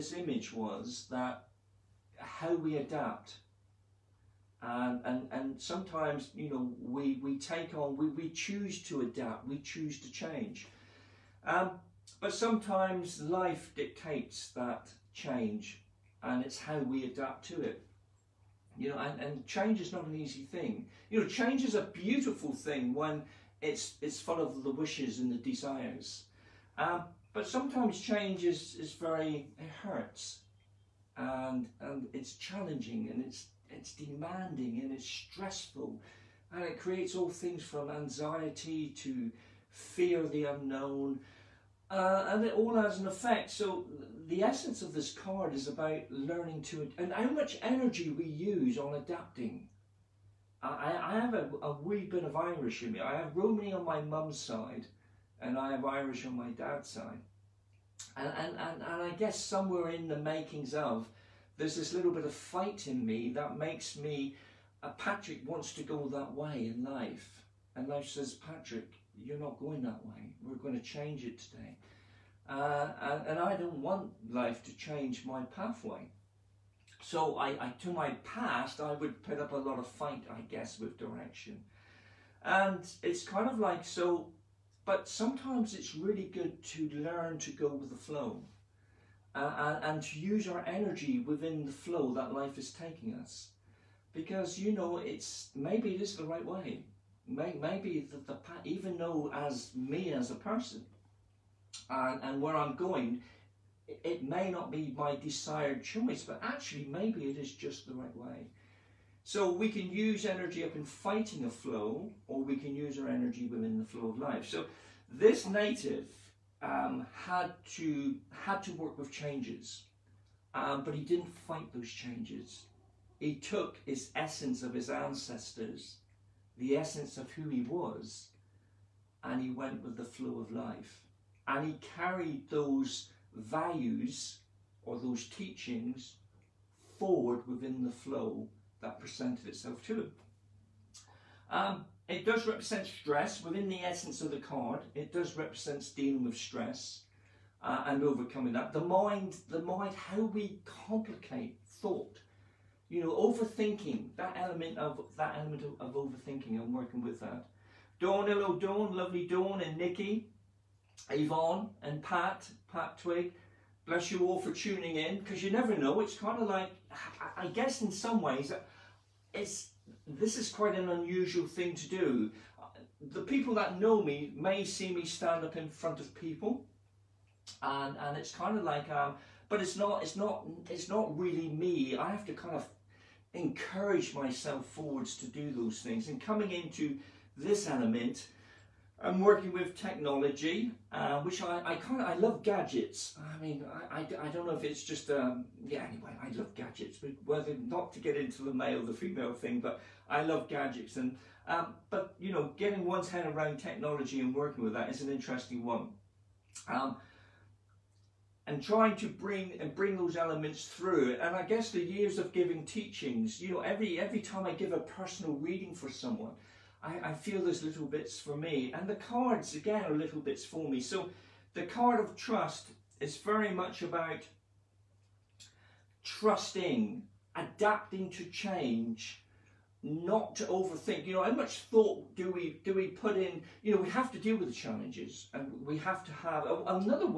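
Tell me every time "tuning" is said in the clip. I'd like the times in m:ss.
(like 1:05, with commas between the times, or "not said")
2:44.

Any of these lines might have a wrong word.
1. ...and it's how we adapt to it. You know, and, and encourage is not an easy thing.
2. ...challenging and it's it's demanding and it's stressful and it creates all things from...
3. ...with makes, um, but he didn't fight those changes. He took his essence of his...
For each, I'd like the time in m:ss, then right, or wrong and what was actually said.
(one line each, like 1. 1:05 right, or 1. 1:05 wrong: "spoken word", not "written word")
1. 0:16 wrong: "change", not "encourage"
2. 0:32 right
3. 1:58 wrong: "changes", not "makes".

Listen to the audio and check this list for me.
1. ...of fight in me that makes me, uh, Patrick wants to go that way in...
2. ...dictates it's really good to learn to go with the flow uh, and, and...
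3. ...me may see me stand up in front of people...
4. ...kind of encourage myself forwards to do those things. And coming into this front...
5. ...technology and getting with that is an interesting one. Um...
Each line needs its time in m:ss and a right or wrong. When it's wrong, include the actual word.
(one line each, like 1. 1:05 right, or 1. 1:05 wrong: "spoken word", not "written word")
1. 1:02 right
2. 1:25 wrong: "sometimes", not "dictates"
3. 2:54 right
4. 3:02 wrong: "element", not "front"
5. 3:23 wrong: "working", not "getting".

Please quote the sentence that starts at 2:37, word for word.
Dawn, hello Dawn, lovely Dawn and Nikki, Yvonne and Pat, Pat Twig.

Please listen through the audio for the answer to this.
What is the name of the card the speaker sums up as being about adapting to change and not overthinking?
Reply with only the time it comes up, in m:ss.
3:41.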